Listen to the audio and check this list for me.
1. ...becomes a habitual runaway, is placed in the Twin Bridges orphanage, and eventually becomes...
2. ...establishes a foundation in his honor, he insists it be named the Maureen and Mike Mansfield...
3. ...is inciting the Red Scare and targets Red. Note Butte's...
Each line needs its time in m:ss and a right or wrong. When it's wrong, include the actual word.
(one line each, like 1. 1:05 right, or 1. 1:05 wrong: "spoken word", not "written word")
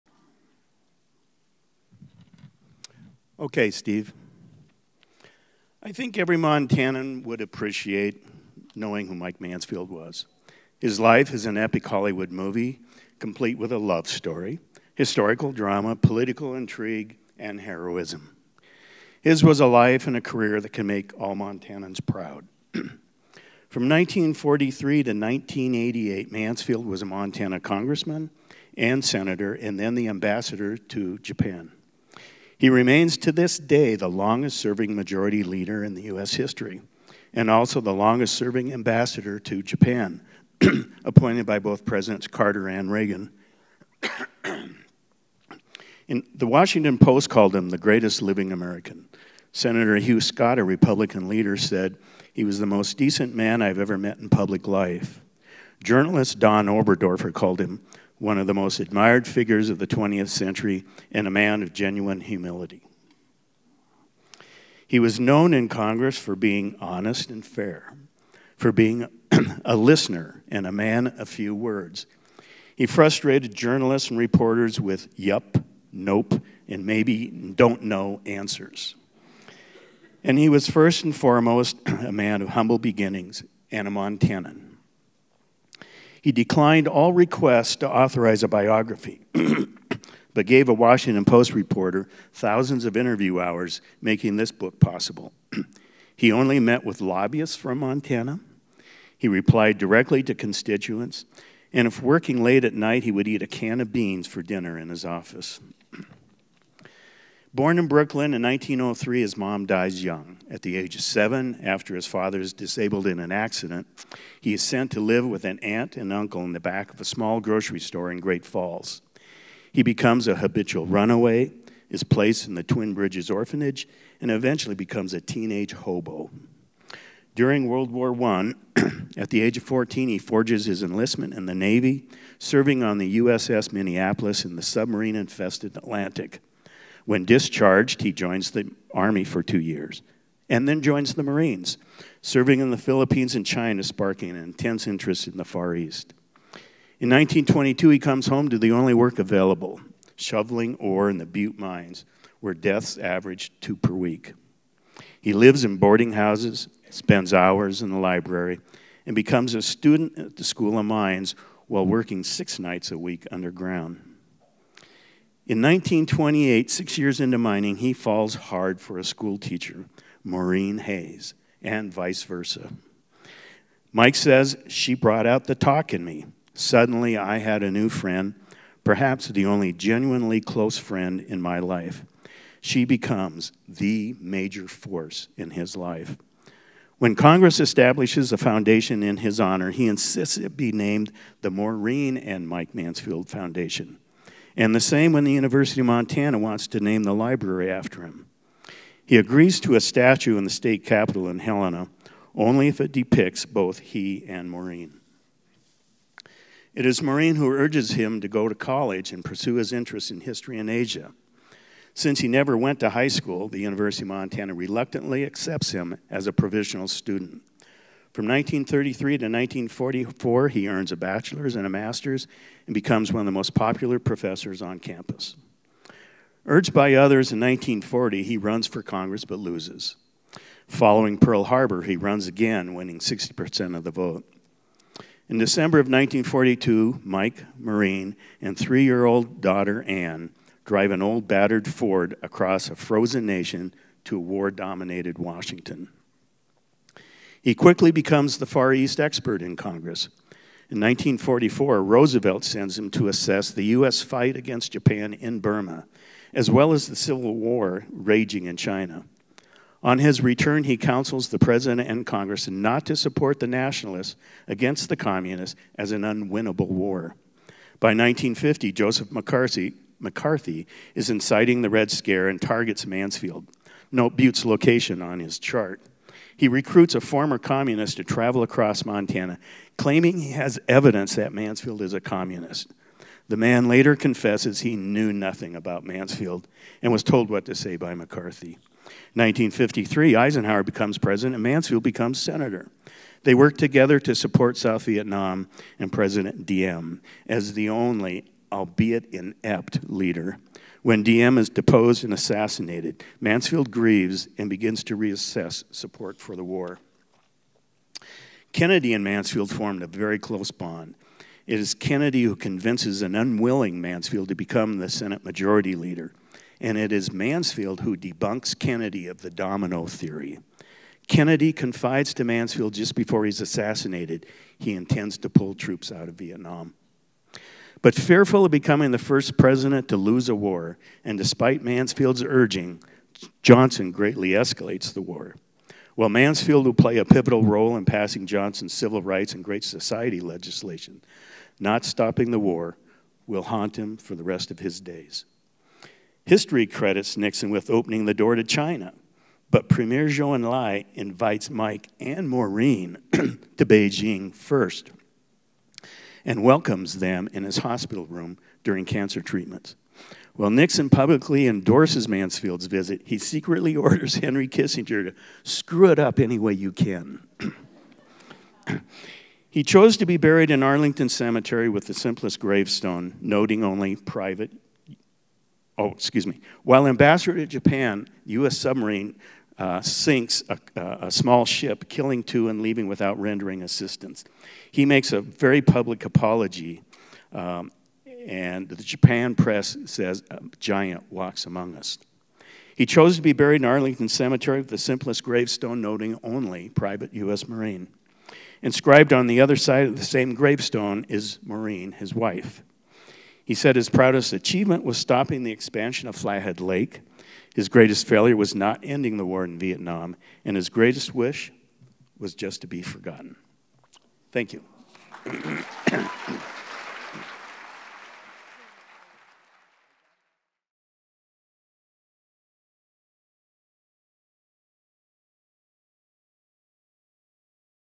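1. 1:59 right
2. 3:07 right
3. 4:30 wrong: "Mansfield", not "Red".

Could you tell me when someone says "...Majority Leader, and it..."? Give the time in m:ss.
5:15.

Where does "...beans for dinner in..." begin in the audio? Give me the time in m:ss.
1:43.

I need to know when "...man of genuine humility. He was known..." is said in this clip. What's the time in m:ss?
1:01.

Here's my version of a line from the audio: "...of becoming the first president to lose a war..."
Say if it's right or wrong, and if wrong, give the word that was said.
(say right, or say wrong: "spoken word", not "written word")
right.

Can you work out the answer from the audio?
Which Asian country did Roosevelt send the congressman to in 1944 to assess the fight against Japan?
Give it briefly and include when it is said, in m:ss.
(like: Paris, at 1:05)
Burma, at 4:15.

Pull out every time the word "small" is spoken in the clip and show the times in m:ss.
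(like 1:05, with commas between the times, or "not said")
1:57, 6:21.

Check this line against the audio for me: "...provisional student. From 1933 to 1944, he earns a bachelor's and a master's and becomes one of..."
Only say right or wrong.
right.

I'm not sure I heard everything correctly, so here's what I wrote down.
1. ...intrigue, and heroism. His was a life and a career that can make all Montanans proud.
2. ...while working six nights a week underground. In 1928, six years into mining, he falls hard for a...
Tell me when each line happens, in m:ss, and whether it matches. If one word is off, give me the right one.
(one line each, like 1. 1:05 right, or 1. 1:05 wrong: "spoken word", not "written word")
1. 0:16 right
2. 2:41 right.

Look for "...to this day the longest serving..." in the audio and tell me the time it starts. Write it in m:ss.
0:33.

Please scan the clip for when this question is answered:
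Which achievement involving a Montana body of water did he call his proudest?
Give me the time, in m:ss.
6:44.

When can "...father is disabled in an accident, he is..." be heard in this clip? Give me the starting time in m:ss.
1:52.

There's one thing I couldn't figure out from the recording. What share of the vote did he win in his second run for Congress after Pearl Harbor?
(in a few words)
60%.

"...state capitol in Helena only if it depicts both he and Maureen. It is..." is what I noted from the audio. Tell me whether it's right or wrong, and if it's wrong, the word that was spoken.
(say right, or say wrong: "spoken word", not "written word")
right.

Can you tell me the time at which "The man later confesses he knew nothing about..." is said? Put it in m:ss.
4:43.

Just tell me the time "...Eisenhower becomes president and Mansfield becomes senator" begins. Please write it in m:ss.
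4:50.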